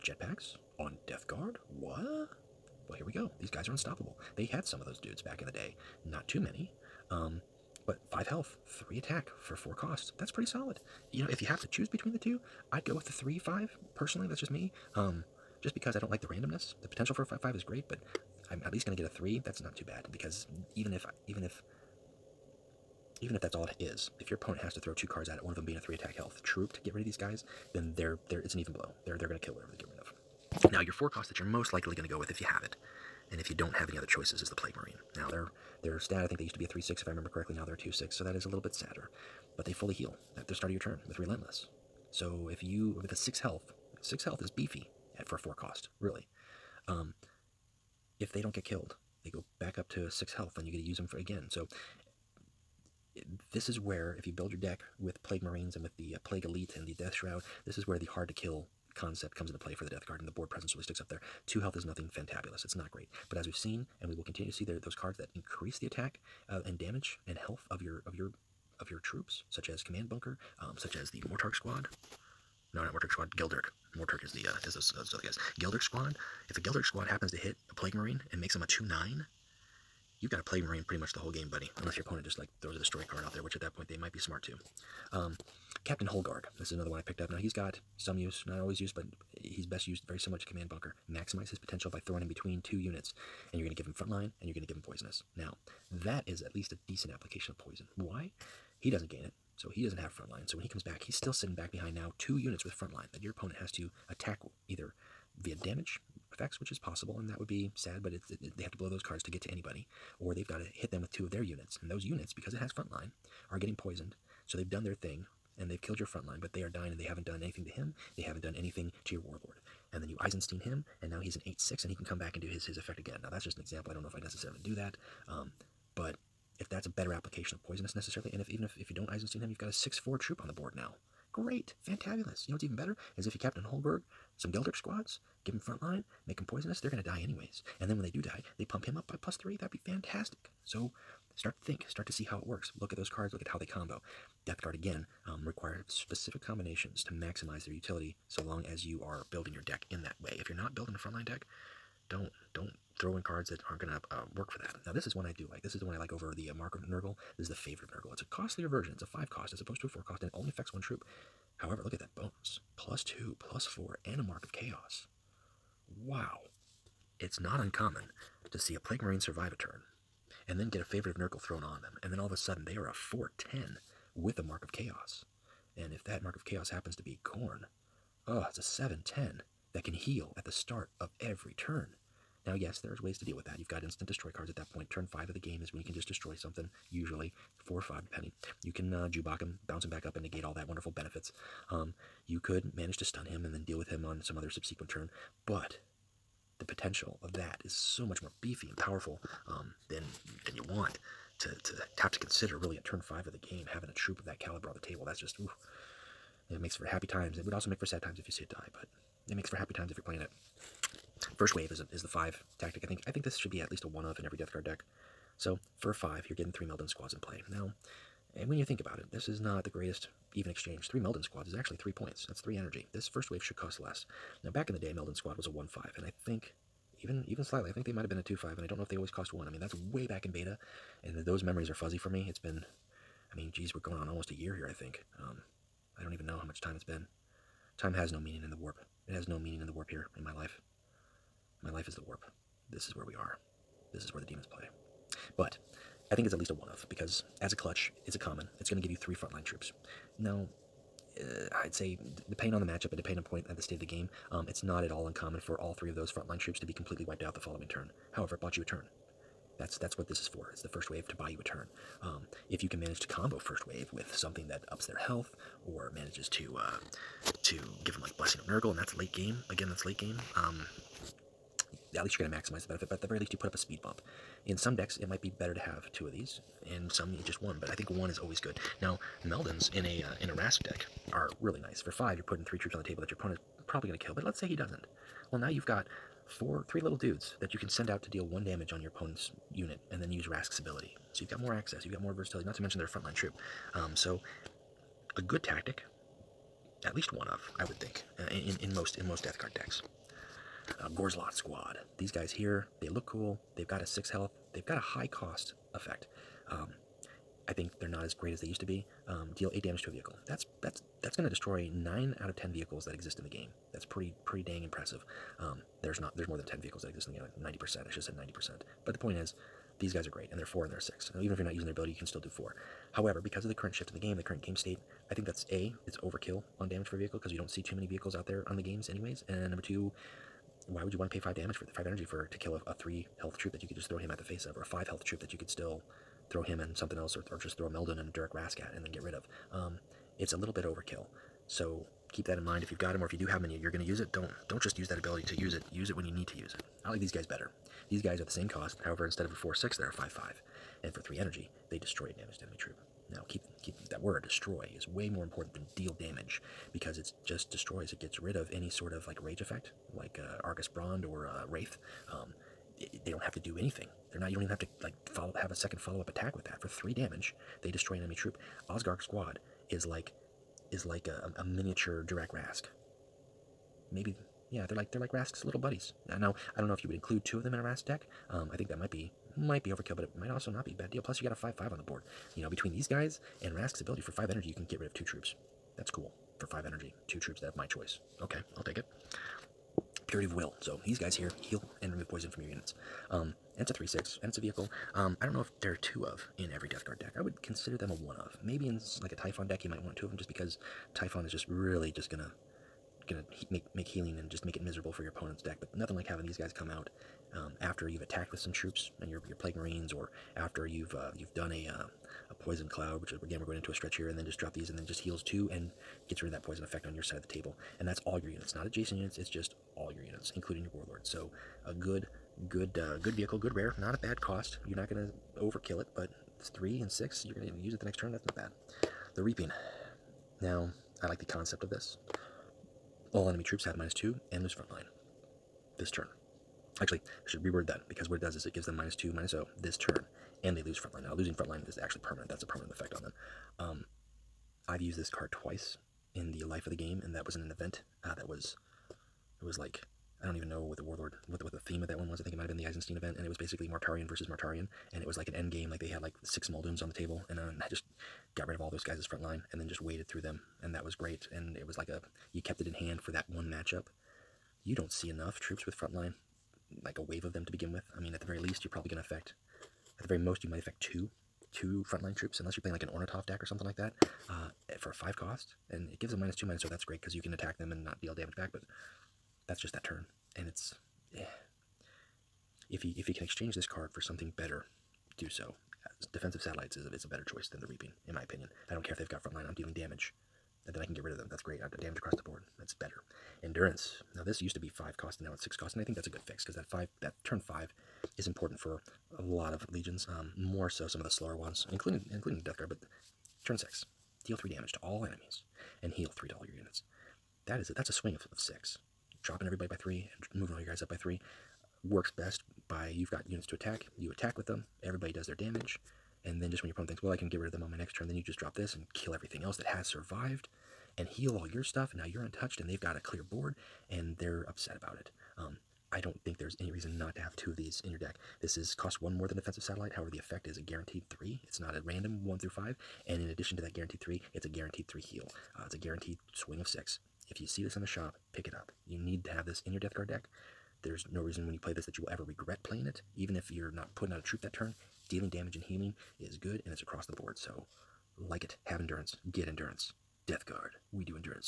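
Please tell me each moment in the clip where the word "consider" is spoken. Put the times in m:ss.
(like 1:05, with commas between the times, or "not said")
3:22, 6:37.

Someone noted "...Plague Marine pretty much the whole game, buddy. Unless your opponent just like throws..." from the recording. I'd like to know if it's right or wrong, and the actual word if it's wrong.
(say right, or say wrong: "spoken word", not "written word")
right.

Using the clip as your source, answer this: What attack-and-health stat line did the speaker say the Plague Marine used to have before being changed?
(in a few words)
3/6.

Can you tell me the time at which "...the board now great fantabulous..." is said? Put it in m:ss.
2:10.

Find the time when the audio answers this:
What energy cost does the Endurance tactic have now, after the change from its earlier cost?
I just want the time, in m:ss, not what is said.
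8:15.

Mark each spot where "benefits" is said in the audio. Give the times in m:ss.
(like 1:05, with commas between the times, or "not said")
3:10, 4:32.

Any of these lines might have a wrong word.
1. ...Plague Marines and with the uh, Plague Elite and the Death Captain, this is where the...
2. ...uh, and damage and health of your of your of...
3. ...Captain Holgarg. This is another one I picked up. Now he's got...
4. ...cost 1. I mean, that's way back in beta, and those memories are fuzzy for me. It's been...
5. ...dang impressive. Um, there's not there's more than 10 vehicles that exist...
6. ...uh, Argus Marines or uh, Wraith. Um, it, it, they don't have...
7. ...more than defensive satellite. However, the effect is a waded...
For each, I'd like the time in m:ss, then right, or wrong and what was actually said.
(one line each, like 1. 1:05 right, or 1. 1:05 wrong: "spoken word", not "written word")
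1. 0:55 wrong: "Shroud", not "Captain"
2. 1:06 right
3. 1:25 right
4. 3:49 right
5. 5:14 right
6. 6:00 wrong: "Brond", not "Marines"
7. 8:49 wrong: "guaranteed", not "waded".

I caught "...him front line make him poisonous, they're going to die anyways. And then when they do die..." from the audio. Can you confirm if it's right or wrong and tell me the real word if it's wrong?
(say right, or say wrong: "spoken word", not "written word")
right.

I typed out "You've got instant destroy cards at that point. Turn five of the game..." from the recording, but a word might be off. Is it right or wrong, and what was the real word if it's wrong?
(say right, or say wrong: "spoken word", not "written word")
right.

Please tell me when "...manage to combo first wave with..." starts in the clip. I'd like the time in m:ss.
4:22.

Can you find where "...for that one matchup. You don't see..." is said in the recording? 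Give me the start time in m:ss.
7:42.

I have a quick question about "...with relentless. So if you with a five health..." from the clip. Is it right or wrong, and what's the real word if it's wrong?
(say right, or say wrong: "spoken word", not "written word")
wrong: "six", not "five".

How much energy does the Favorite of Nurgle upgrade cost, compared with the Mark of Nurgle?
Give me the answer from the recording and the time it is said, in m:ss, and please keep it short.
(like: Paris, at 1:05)
5, at 2:39.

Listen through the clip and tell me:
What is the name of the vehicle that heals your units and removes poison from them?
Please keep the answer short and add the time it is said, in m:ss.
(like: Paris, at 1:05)
Purity of Will, at 6:30.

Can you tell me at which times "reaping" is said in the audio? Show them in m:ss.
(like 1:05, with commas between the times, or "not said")
7:09, 8:07.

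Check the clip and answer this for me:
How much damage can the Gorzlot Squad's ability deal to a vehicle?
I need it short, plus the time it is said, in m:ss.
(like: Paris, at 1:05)
8, at 5:09.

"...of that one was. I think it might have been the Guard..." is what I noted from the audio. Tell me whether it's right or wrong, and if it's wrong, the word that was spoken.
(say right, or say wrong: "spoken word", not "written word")
wrong: "Eisenstein", not "Guard".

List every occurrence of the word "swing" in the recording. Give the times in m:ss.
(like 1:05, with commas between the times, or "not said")
8:27, 8:56.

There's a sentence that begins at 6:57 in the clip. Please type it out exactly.
And that's all your units, not adjacent units, it's just all your units, including your warlord.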